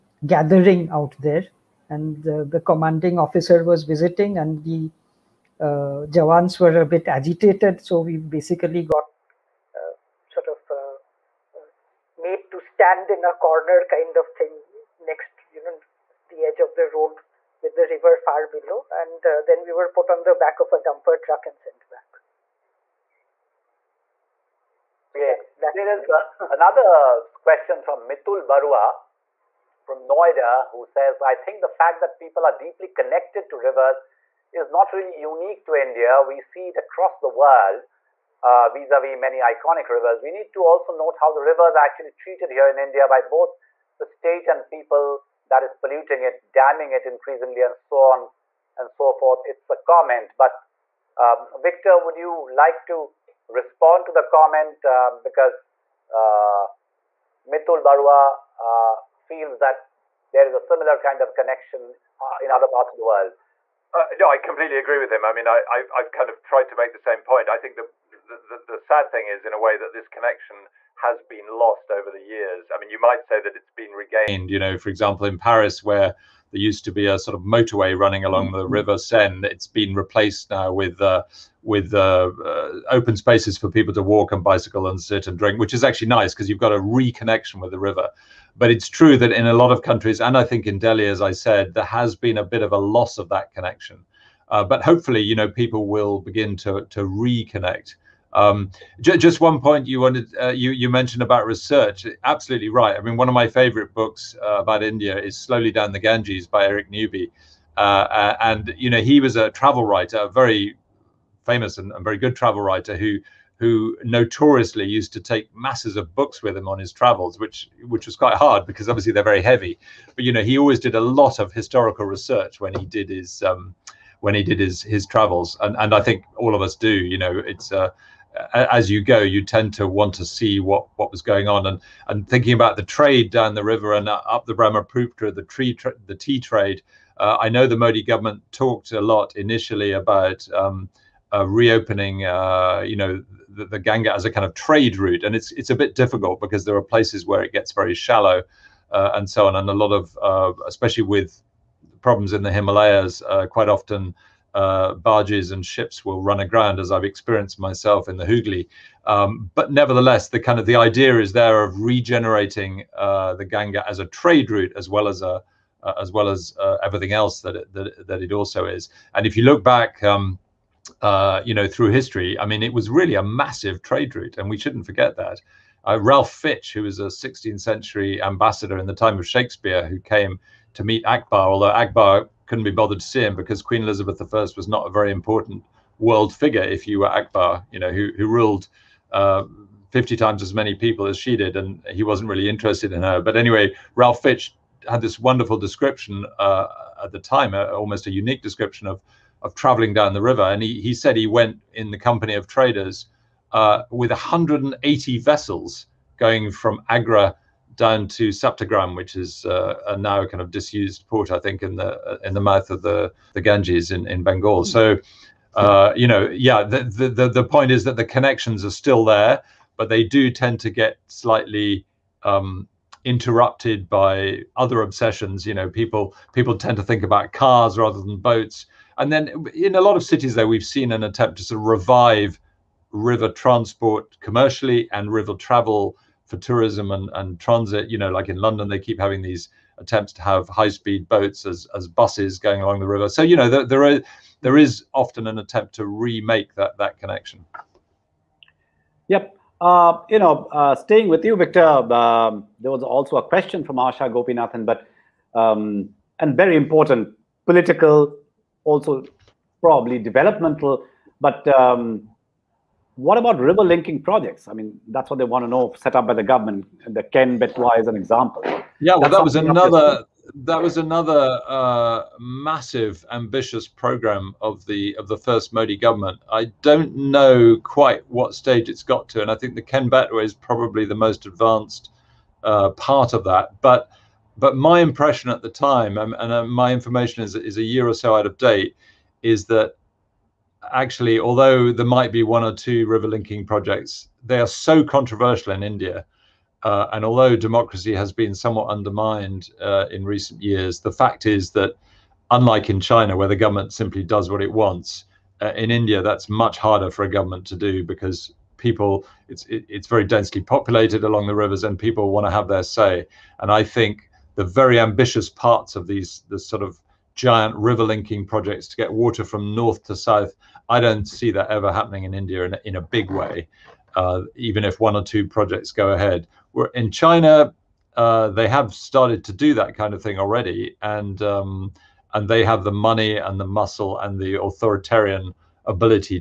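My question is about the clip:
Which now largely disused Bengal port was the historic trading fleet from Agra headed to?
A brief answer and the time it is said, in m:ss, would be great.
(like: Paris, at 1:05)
Saptagram, at 3:28.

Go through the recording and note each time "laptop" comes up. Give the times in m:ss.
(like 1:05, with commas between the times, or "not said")
not said.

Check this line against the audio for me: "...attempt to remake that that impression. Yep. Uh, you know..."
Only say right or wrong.
wrong.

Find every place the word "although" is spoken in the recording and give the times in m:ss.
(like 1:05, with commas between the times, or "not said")
3:01, 4:51, 4:57.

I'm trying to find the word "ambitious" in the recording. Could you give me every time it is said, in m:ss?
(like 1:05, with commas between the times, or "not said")
4:33, 5:14.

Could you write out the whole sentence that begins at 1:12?
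I mean, you might say that it's been regained.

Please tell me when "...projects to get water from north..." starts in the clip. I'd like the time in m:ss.
5:18.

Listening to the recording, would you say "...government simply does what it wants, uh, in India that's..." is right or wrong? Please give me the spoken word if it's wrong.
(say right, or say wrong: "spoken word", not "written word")
right.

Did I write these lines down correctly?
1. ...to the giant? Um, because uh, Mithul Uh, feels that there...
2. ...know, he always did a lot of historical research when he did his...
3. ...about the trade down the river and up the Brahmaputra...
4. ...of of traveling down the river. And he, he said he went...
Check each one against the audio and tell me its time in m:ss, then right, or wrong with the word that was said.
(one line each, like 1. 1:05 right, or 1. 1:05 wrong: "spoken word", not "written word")
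1. 0:54 wrong: "comment", not "giant"
2. 2:00 right
3. 2:12 right
4. 3:18 right.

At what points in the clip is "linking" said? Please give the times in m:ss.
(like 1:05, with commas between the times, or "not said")
4:23, 4:53, 5:17.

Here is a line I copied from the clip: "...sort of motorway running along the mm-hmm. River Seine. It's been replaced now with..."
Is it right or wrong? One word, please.
right.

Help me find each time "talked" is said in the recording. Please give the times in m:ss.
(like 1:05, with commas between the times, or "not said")
2:18.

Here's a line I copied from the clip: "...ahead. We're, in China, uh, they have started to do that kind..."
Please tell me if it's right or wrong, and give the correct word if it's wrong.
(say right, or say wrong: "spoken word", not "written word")
right.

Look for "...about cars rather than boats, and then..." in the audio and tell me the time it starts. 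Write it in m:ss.
3:47.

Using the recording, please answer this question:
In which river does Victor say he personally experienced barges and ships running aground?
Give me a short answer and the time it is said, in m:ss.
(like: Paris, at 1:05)
Hooghly, at 2:38.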